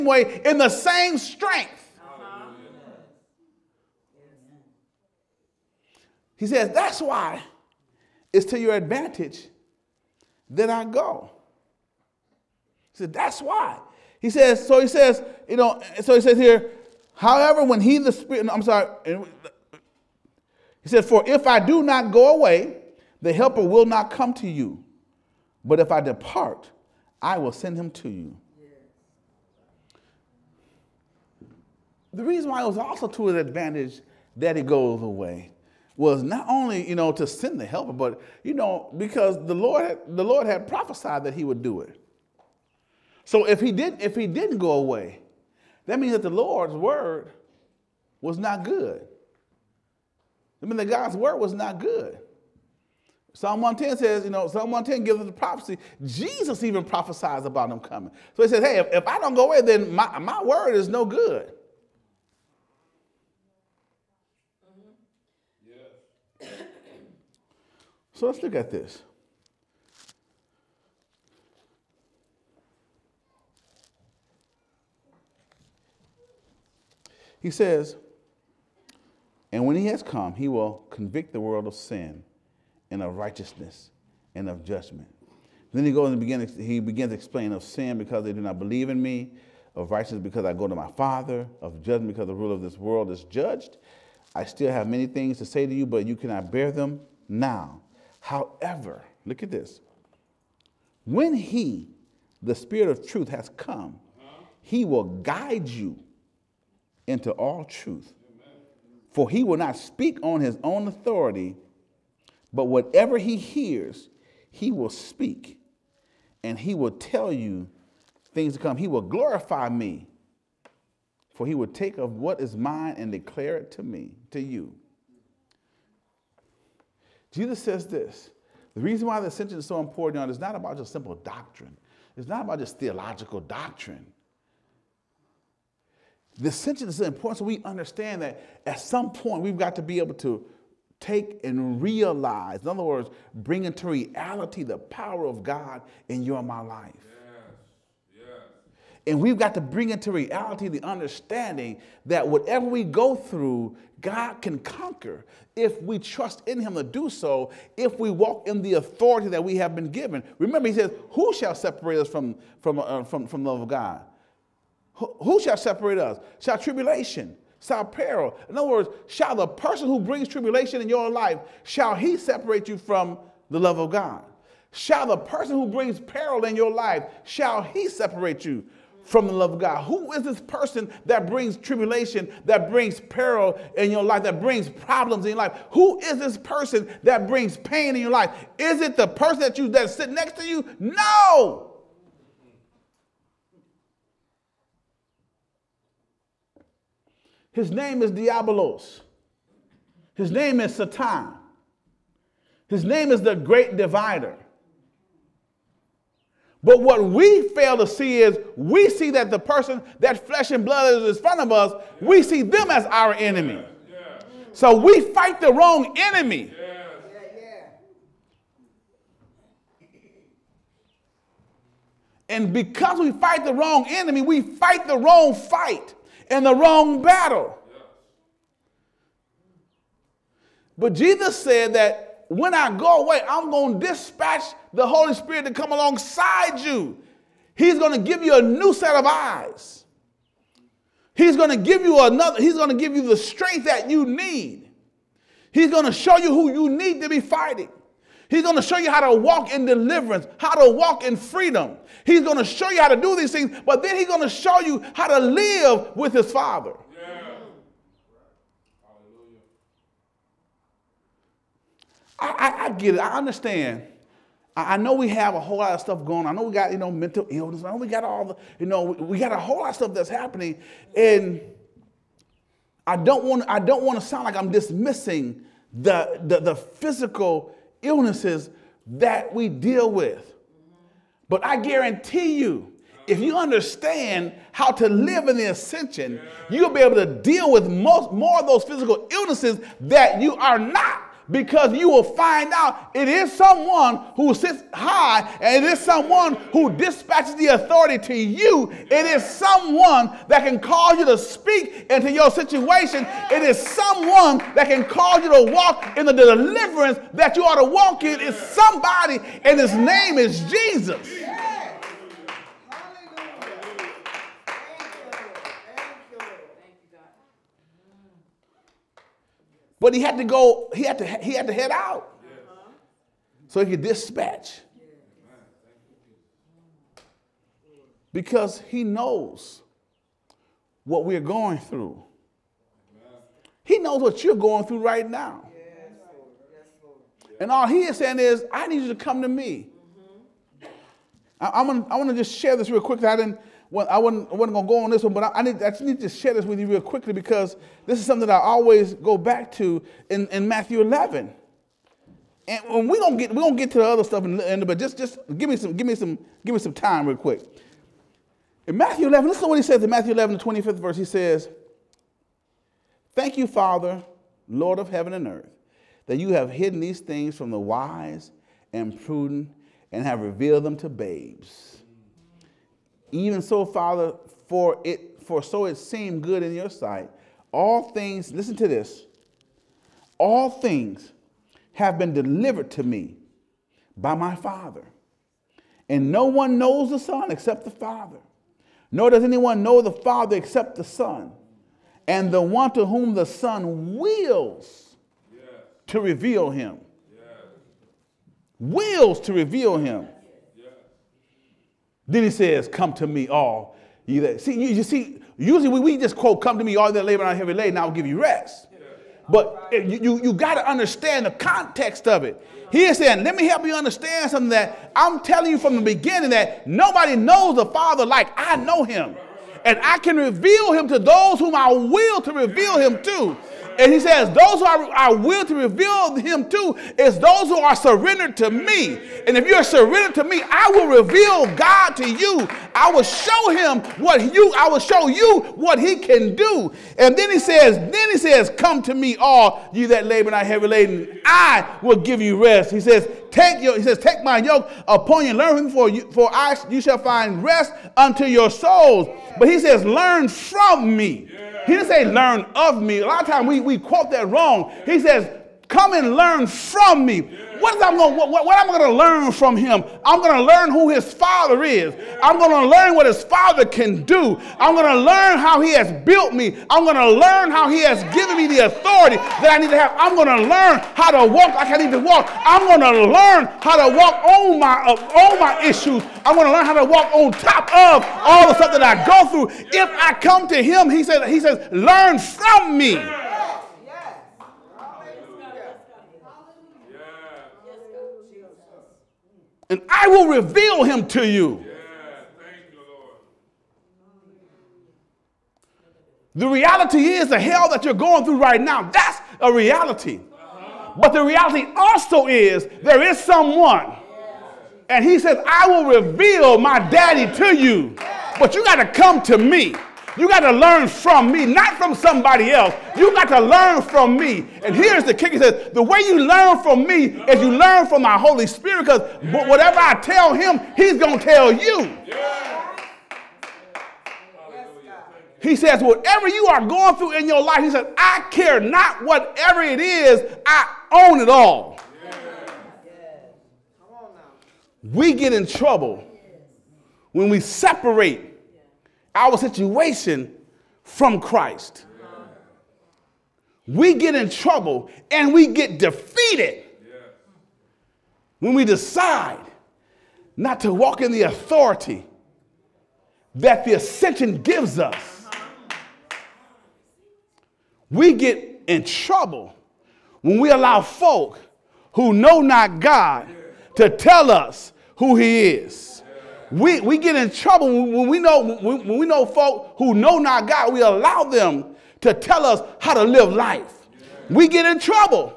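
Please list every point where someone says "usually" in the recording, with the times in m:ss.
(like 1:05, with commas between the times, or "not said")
6:45.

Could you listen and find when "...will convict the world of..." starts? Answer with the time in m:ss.
1:20.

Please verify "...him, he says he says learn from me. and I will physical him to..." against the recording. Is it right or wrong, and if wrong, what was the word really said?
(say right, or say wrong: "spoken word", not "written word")
wrong: "reveal", not "physical".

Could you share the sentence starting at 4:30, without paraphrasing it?
And I don't want I don't want to sound like I'm dismissing the, the, the physical illnesses that we deal with.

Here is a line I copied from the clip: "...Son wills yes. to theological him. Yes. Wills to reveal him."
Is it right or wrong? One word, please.
wrong.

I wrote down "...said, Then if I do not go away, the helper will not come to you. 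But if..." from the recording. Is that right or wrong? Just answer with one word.
wrong.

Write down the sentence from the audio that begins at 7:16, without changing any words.
And then he says, Then he says, Come to me, all you that labor and are heavy laden.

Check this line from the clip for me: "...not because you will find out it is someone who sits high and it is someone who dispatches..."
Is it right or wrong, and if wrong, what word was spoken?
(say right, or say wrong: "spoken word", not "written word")
right.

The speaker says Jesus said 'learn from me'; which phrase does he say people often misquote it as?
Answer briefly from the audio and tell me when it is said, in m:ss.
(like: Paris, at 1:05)
Learn of me, at 7:32.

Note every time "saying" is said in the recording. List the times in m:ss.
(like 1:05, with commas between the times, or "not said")
5:37, 6:52.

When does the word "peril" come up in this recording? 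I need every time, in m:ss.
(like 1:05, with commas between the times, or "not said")
2:47, 2:56, 3:02.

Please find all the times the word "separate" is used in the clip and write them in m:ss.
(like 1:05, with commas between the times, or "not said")
2:41, 2:45, 2:52, 2:57, 8:57.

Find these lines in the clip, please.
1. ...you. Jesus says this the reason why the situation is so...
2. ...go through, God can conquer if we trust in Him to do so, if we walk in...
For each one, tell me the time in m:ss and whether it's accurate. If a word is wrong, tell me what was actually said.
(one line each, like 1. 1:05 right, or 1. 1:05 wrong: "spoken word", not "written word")
1. 2:04 wrong: "ascension", not "situation"
2. 2:32 right.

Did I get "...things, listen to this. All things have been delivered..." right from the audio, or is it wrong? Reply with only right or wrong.
right.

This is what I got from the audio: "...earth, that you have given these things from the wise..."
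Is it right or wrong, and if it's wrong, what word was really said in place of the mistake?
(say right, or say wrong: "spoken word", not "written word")
wrong: "hidden", not "given".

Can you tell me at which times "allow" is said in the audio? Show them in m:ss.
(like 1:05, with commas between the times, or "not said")
9:20, 9:30.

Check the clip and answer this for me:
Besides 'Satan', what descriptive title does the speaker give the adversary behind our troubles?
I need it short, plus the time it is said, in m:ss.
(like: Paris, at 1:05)
The great divider, at 3:23.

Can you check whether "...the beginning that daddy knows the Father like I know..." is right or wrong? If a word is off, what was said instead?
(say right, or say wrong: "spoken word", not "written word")
wrong: "nobody", not "daddy".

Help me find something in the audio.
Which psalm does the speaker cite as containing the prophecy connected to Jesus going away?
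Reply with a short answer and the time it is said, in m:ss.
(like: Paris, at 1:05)
Psalm 110, at 0:54.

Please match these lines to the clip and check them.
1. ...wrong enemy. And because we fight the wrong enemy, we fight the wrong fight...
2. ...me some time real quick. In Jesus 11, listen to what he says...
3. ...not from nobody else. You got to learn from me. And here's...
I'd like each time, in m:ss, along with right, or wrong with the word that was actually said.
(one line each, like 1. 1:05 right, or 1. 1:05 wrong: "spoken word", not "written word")
1. 3:35 right
2. 5:56 wrong: "Matthew", not "Jesus"
3. 8:31 wrong: "somebody", not "nobody".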